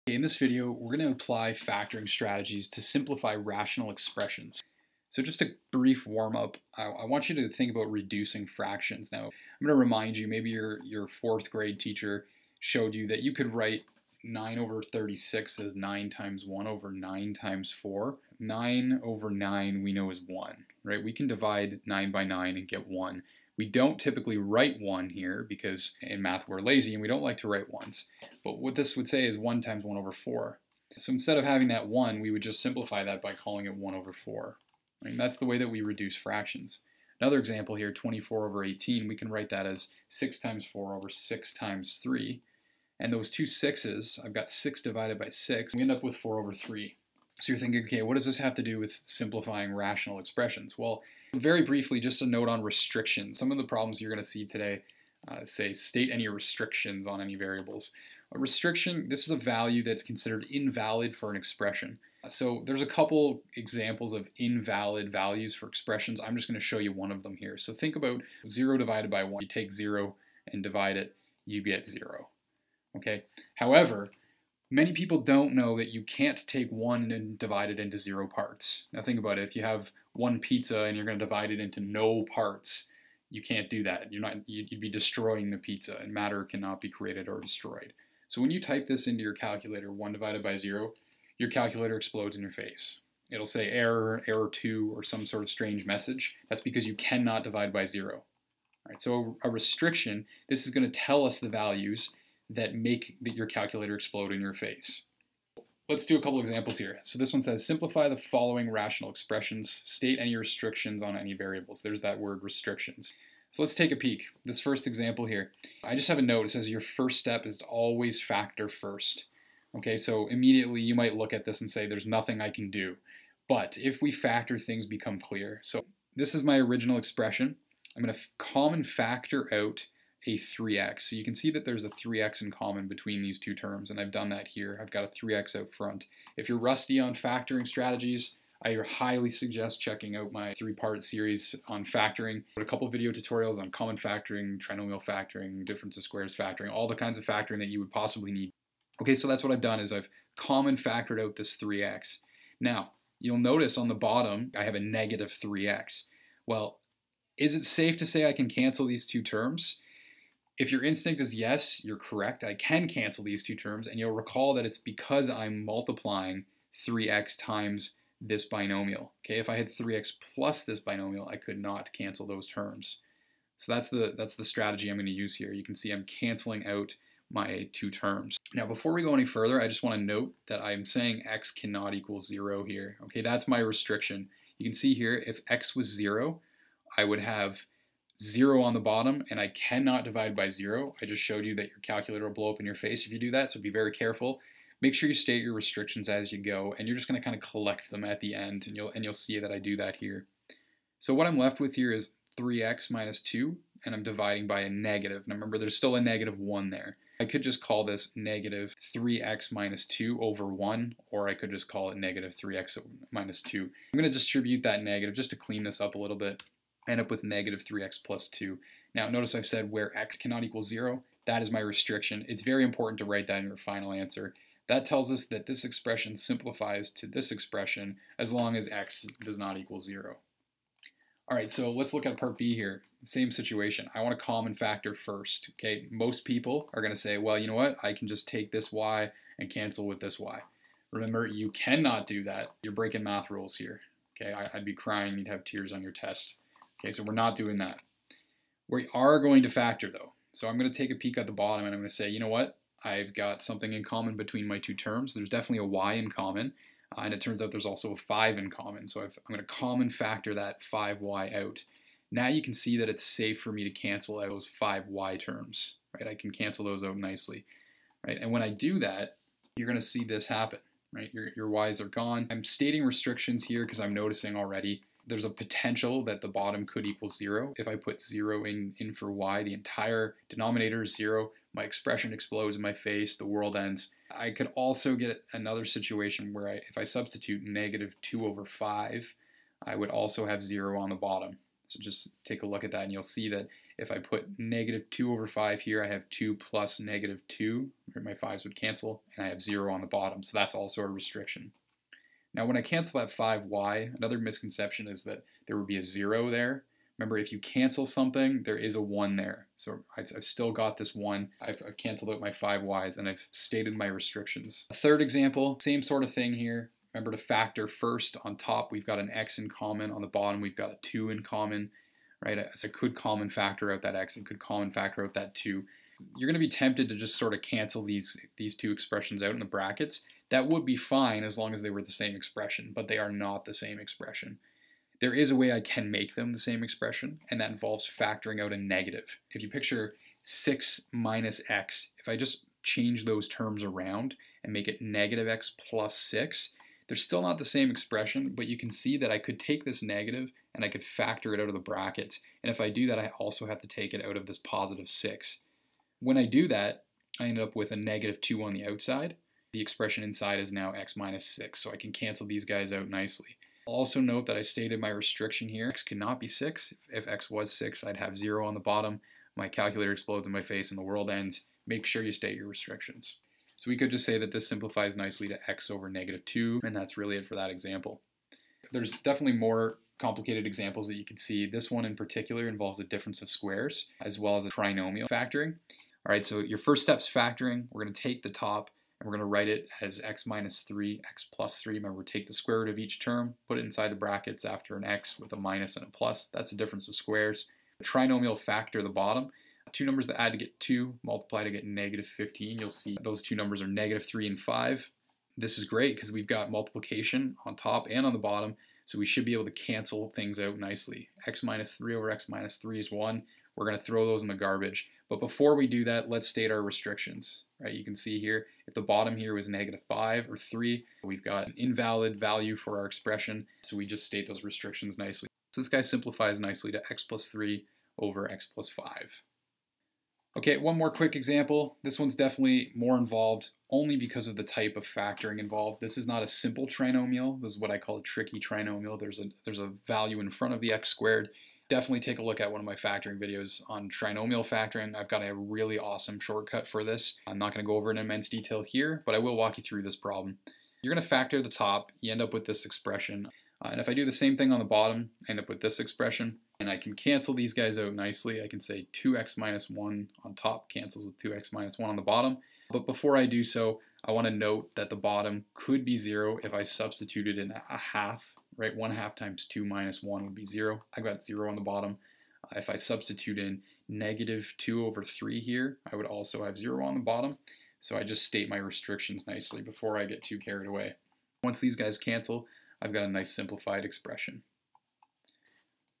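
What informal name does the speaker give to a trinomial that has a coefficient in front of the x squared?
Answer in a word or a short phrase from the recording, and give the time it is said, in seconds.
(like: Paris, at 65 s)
tricky trinomial, at 438 s.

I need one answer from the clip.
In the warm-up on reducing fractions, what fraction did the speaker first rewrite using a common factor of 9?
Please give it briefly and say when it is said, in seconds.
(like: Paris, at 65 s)
9/36, at 14 s.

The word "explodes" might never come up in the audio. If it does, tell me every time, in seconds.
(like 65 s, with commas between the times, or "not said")
91 s, 103 s, 282 s, 369 s.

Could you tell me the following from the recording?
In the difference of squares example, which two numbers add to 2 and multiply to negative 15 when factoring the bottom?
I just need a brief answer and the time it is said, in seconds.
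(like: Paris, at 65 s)
-3 and 5, at 403 s.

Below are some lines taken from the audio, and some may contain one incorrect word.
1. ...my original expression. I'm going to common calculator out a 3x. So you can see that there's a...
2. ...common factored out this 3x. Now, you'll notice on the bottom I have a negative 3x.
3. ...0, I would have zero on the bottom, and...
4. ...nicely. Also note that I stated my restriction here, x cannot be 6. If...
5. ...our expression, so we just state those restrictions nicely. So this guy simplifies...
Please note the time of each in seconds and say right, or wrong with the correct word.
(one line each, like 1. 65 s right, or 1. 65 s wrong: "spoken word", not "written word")
1. 126 s wrong: "factor", not "calculator"
2. 150 s right
3. 185 s right
4. 362 s right
5. 422 s right.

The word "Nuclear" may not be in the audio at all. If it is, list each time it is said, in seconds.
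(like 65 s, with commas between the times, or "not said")
not said.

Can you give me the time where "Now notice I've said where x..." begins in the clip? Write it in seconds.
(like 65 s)
218 s.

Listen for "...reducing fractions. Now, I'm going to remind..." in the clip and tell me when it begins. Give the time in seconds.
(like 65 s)
7 s.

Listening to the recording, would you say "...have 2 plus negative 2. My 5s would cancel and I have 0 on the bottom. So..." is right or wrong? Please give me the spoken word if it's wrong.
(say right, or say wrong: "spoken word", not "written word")
right.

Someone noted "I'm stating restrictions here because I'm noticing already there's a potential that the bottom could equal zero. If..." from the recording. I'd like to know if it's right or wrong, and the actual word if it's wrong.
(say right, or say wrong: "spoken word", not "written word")
right.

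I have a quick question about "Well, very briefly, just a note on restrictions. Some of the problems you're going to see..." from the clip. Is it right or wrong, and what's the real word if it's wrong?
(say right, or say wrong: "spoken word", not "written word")
right.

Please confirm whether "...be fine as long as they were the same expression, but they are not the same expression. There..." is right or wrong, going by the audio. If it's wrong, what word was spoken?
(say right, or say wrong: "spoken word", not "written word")
right.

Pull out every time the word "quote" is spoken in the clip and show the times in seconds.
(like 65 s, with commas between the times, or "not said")
not said.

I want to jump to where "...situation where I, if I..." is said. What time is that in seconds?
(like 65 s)
285 s.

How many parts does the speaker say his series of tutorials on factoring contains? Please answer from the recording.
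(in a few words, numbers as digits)
3.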